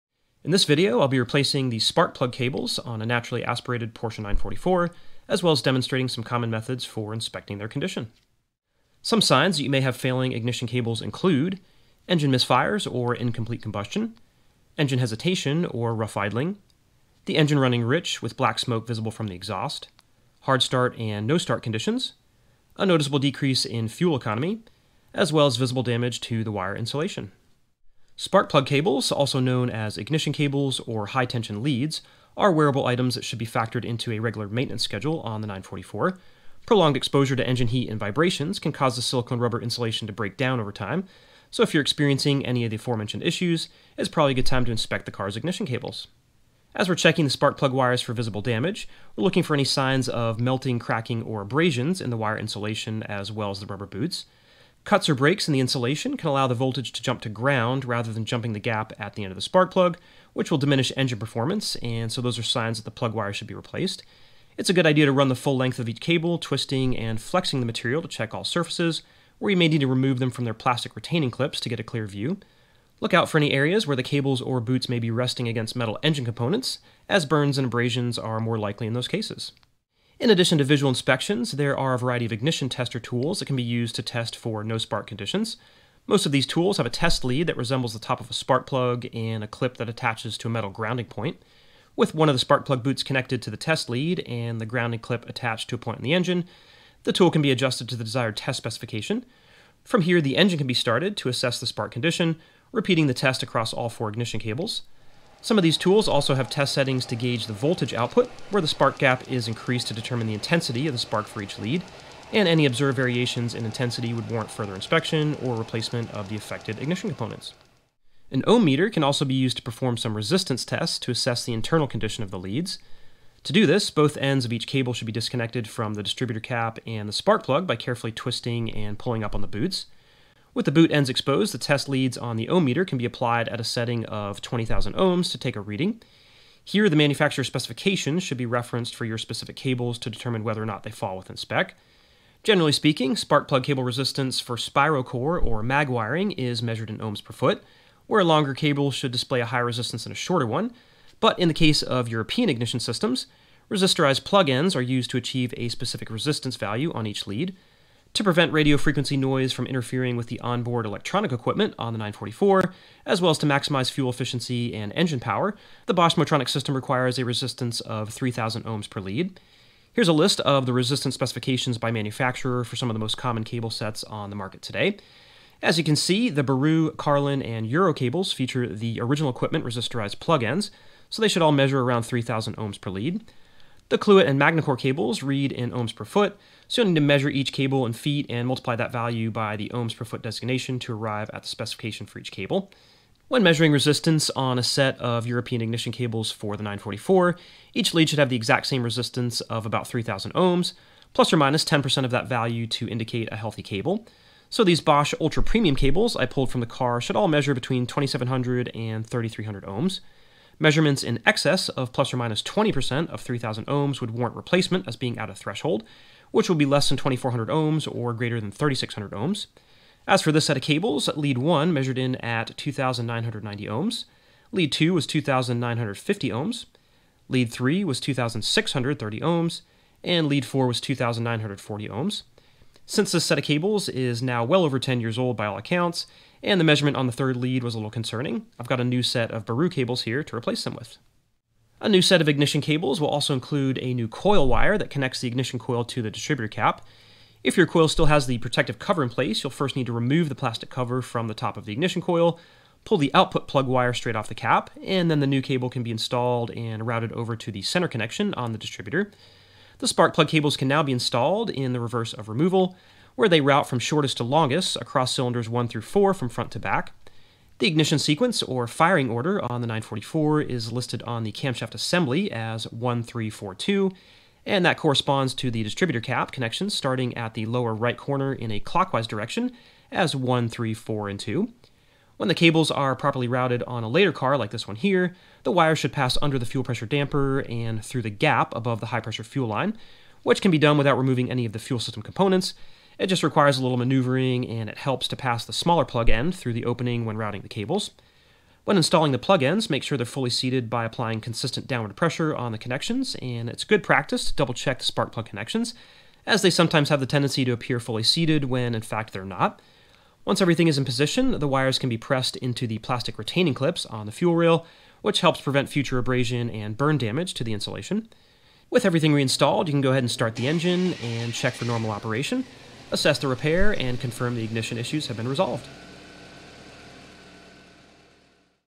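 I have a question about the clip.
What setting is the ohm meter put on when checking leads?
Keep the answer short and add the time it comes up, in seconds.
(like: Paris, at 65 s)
20,000 ohms, at 134 s.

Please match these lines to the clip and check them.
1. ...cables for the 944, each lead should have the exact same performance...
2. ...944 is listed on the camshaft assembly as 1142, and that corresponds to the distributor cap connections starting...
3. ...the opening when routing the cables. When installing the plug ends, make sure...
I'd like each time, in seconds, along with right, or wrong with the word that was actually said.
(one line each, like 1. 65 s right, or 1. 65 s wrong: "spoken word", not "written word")
1. 195 s wrong: "resistance", not "performance"
2. 269 s wrong: "1342", not "1142"
3. 296 s right.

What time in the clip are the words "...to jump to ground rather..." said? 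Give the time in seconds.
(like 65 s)
56 s.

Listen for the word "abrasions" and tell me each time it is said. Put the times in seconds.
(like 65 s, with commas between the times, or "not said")
51 s, 77 s, 315 s.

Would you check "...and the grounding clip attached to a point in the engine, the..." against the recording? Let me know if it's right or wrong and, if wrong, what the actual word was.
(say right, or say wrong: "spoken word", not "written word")
right.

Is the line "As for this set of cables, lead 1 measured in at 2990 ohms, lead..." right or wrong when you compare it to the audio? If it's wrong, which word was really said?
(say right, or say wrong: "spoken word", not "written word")
right.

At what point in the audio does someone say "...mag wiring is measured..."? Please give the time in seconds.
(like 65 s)
145 s.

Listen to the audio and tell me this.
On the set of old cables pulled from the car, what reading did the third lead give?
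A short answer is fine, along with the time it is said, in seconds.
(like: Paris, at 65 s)
2630 ohms, at 227 s.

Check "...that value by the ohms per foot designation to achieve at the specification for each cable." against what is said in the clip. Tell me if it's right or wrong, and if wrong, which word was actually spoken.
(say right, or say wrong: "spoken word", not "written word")
wrong: "arrive", not "achieve".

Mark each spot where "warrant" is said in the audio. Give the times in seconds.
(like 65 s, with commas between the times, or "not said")
114 s, 214 s.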